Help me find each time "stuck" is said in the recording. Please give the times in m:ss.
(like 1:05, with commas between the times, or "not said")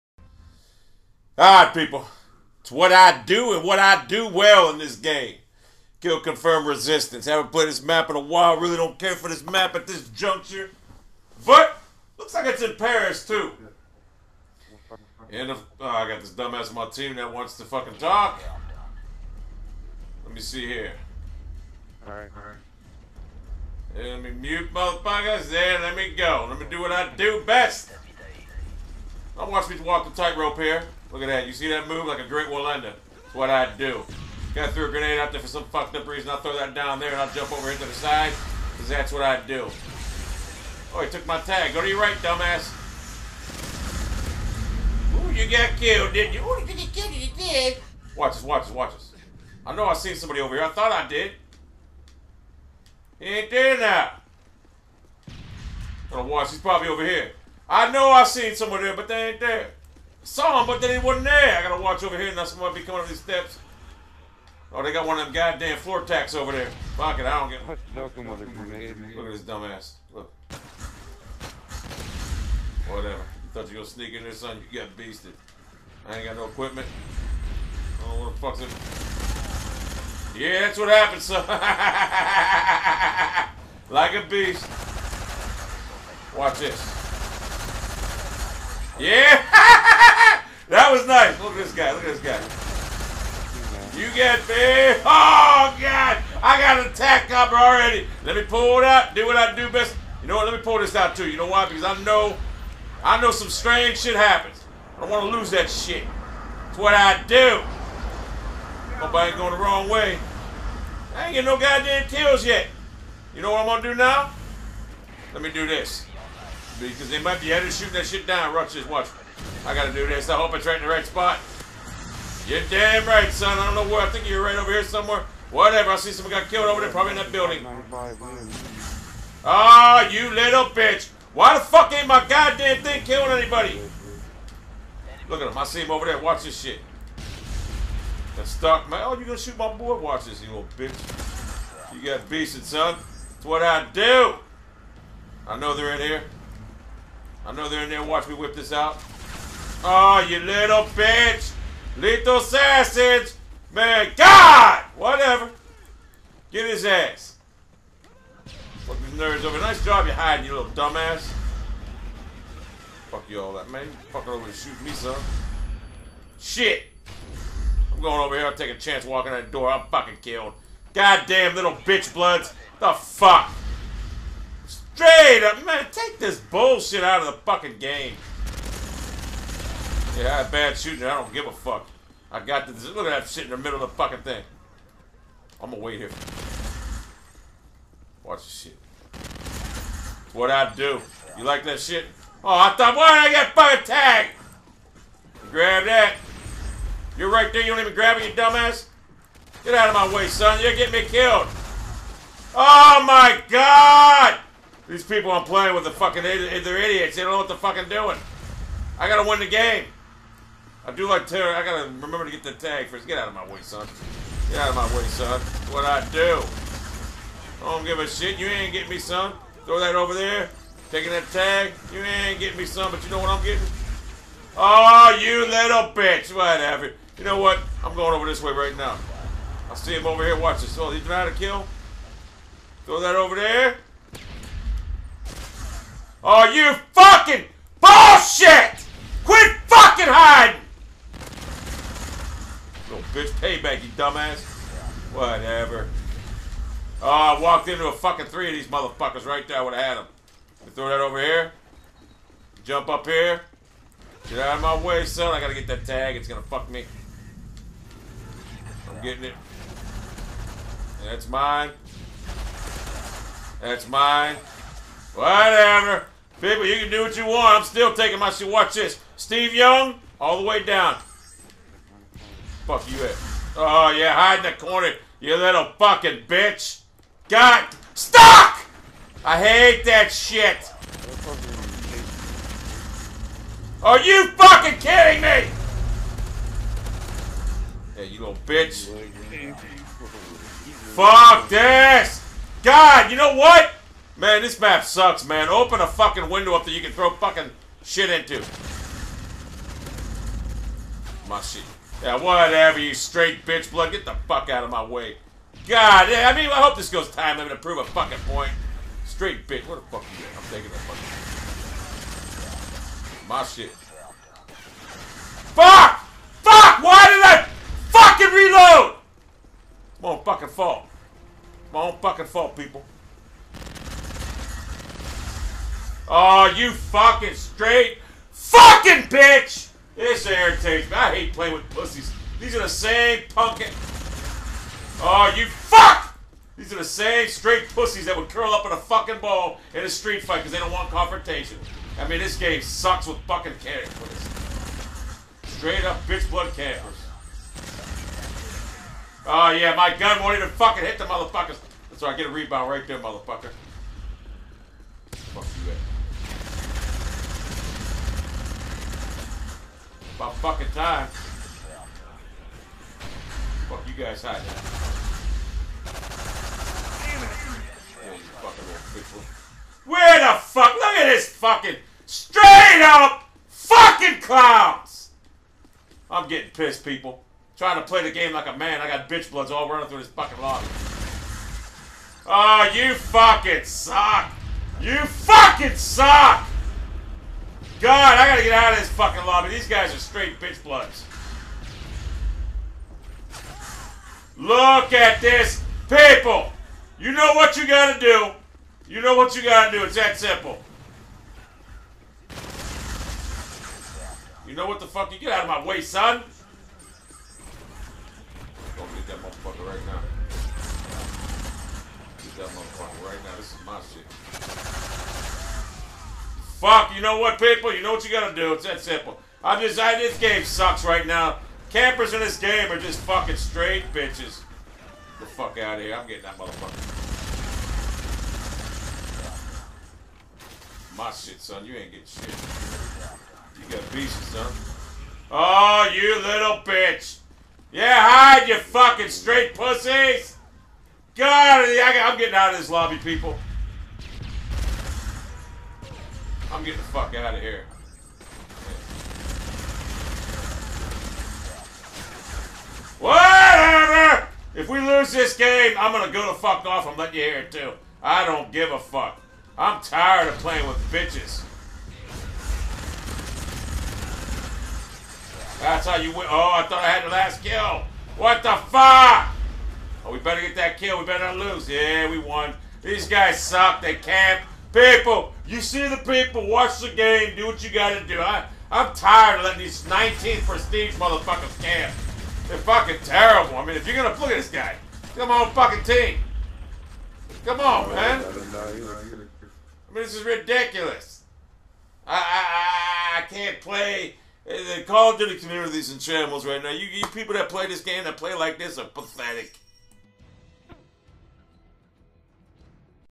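4:37.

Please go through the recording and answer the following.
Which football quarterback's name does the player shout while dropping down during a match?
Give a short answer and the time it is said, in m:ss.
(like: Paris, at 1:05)
Steve Young, at 4:29.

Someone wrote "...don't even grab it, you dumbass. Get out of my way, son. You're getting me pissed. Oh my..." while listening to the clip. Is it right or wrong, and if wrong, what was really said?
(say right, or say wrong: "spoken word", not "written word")
wrong: "killed", not "pissed".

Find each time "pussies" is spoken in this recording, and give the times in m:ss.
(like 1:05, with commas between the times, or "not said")
5:31, 5:37, 7:19.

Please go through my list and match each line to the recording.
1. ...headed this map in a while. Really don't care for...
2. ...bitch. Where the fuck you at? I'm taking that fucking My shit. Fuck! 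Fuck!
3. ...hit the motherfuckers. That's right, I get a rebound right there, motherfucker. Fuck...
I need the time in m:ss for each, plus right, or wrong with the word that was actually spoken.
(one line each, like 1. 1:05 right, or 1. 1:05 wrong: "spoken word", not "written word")
1. 0:07 wrong: "played", not "headed"
2. 5:09 right
3. 5:50 right.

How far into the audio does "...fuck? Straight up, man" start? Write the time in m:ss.
2:52.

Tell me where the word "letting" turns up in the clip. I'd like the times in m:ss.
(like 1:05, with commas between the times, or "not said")
7:59.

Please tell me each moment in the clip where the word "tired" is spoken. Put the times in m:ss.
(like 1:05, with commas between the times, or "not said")
7:39, 7:58.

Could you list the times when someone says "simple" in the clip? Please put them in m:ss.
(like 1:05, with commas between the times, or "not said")
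6:40, 6:58.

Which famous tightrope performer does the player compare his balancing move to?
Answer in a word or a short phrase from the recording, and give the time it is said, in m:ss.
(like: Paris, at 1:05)
Wallenda, at 0:32.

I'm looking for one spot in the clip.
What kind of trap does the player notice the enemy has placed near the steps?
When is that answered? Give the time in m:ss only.
1:05.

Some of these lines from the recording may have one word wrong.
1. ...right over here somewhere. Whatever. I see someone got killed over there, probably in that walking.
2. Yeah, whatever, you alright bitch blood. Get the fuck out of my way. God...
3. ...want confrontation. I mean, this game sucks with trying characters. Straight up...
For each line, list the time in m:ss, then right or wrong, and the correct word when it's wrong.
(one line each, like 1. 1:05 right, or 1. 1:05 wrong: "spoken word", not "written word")
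1. 2:04 wrong: "building", not "walking"
2. 5:02 wrong: "straight", not "alright"
3. 5:40 wrong: "fucking", not "trying".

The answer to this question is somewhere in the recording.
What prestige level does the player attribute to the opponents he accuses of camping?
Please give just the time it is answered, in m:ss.
7:59.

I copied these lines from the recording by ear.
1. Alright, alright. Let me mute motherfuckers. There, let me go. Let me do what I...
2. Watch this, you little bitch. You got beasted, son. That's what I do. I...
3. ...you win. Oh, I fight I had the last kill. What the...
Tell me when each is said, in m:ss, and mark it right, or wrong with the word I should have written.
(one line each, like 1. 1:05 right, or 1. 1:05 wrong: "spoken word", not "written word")
1. 0:22 right
2. 2:19 right
3. 7:45 wrong: "thought", not "fight".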